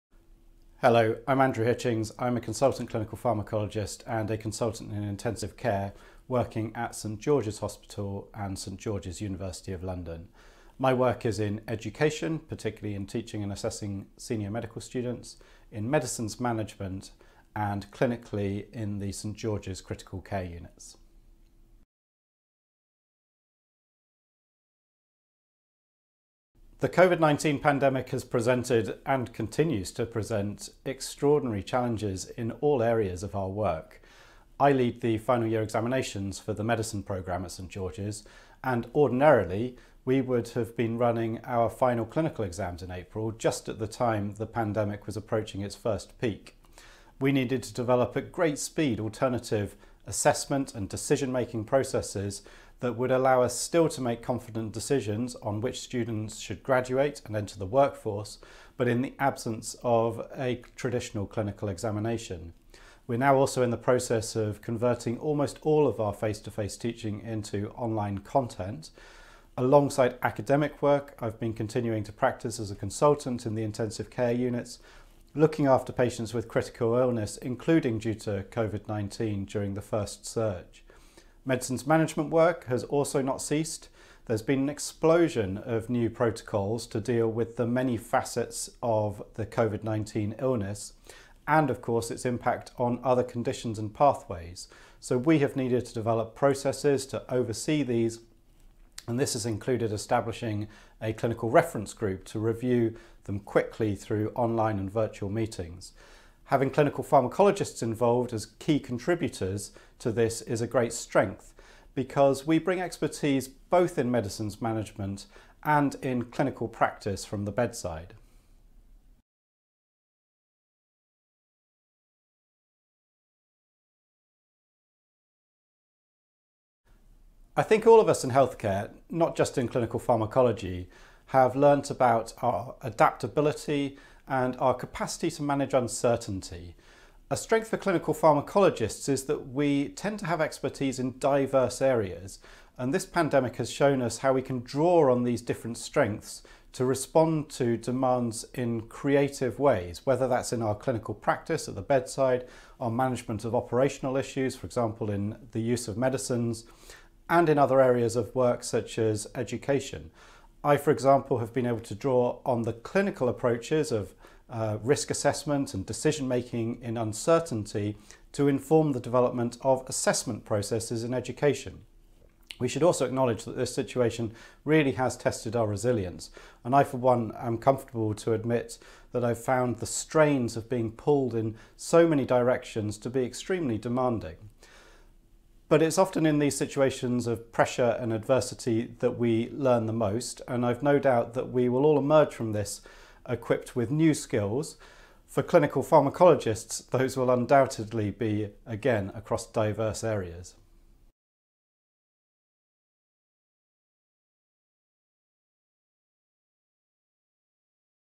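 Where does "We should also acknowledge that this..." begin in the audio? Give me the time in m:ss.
2:52.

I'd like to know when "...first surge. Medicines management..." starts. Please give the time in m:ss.
1:19.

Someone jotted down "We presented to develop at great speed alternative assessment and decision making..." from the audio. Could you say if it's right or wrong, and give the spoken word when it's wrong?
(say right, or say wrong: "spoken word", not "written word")
wrong: "needed", not "presented".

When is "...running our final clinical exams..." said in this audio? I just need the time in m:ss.
0:40.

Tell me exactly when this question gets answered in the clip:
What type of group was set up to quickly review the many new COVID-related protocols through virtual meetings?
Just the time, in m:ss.
1:41.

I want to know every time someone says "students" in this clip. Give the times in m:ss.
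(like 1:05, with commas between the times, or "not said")
0:14, 0:55.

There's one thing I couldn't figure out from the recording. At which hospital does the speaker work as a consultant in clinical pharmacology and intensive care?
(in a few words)
St George's Hospital.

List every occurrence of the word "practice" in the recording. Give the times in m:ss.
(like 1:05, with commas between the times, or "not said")
1:12, 1:56, 2:31.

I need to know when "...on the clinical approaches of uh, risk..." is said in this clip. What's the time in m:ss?
2:42.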